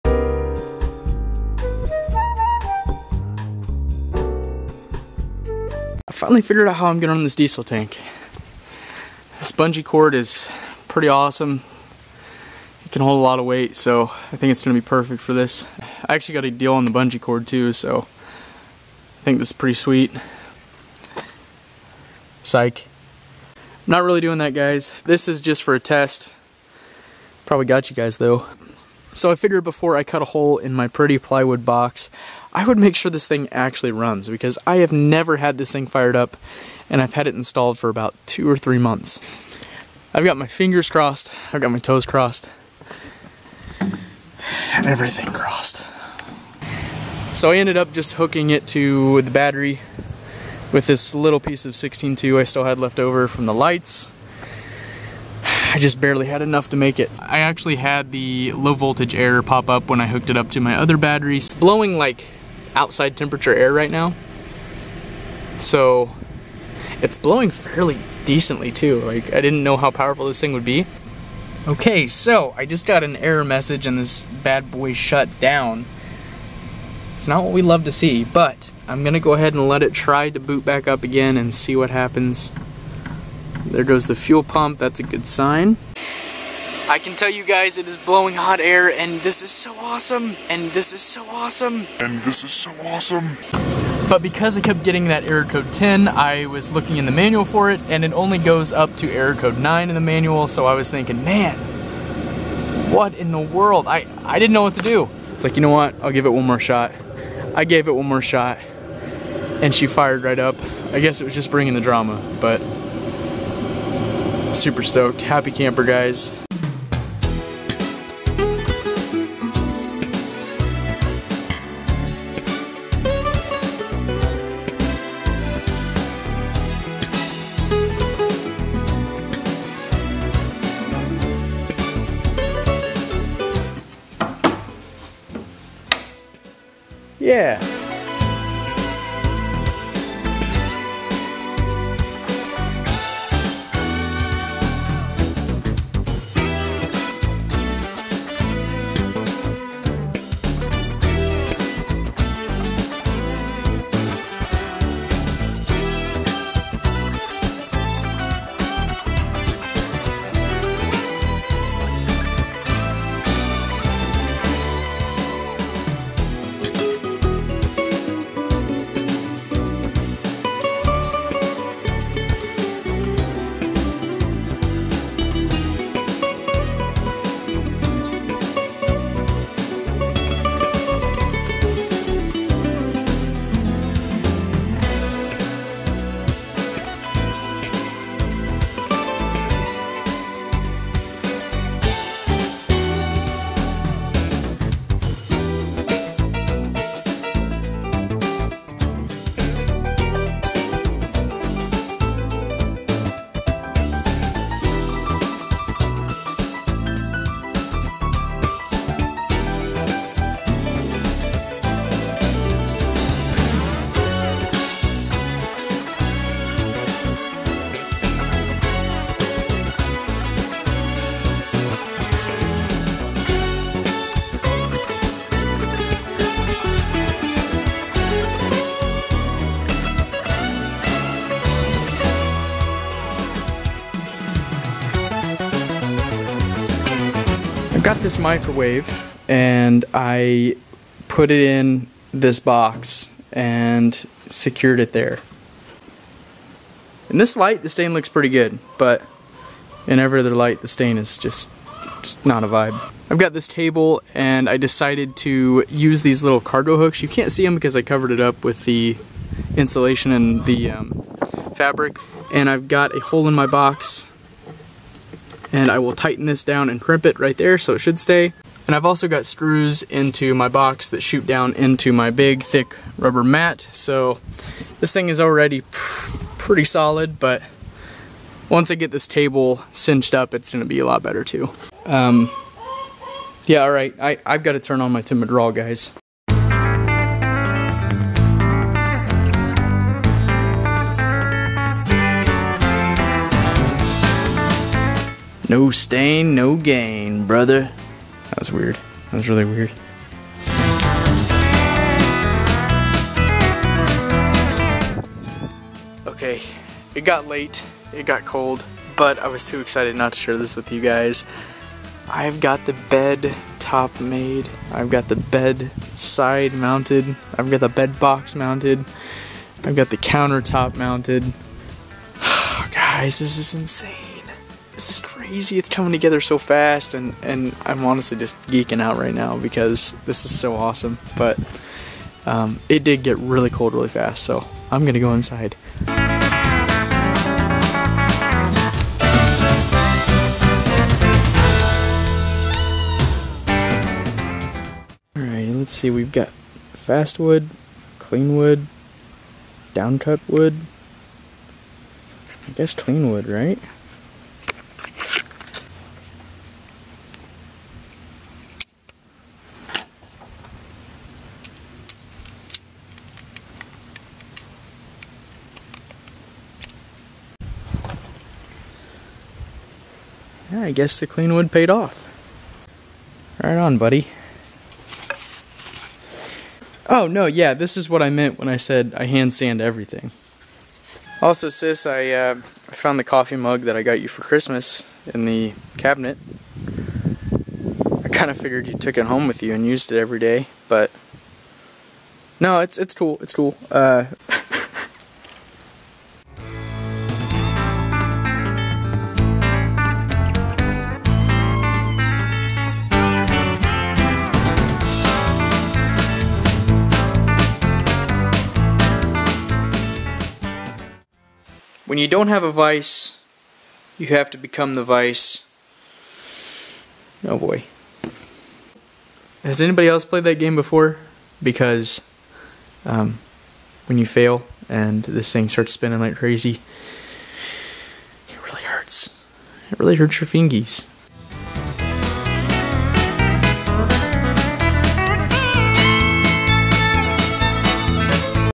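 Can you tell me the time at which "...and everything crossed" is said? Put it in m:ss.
0:43.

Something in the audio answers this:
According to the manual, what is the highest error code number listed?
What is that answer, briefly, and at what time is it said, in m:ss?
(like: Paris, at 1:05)
9, at 1:39.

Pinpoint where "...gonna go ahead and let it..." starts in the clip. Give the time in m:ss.
1:19.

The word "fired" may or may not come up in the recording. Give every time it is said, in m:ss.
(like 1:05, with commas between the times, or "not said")
0:35, 1:49.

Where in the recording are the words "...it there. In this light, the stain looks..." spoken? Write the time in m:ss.
4:04.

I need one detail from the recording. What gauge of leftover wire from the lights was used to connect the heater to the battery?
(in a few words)
16.2.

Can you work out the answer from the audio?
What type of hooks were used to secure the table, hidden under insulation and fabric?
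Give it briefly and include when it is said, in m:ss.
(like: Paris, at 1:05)
cargo hooks, at 4:16.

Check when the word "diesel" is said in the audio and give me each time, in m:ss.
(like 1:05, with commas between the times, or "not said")
0:07.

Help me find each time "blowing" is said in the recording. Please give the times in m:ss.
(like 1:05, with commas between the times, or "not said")
1:01, 1:07, 1:27.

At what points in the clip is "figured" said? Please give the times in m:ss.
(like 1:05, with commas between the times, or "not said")
0:06, 0:29, 6:28.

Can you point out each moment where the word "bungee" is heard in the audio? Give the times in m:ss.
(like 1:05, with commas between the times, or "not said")
0:09, 0:16.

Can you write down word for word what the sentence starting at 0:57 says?
I actually had the low voltage error pop up when I hooked it up to my other battery.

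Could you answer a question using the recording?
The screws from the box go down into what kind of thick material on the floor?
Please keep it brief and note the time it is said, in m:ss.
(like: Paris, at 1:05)
rubber mat, at 4:32.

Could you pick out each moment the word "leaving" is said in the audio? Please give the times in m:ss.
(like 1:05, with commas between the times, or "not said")
not said.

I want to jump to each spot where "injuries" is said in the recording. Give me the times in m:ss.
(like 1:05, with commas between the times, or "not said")
not said.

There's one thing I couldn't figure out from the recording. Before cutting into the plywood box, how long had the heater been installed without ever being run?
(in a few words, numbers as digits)
2 or 3 months.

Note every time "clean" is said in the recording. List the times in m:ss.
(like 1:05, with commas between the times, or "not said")
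5:47, 5:52, 6:11.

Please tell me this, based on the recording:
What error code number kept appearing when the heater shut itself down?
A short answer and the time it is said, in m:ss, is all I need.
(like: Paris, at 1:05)
10, at 1:35.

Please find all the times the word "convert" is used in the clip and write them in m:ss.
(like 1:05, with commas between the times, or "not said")
not said.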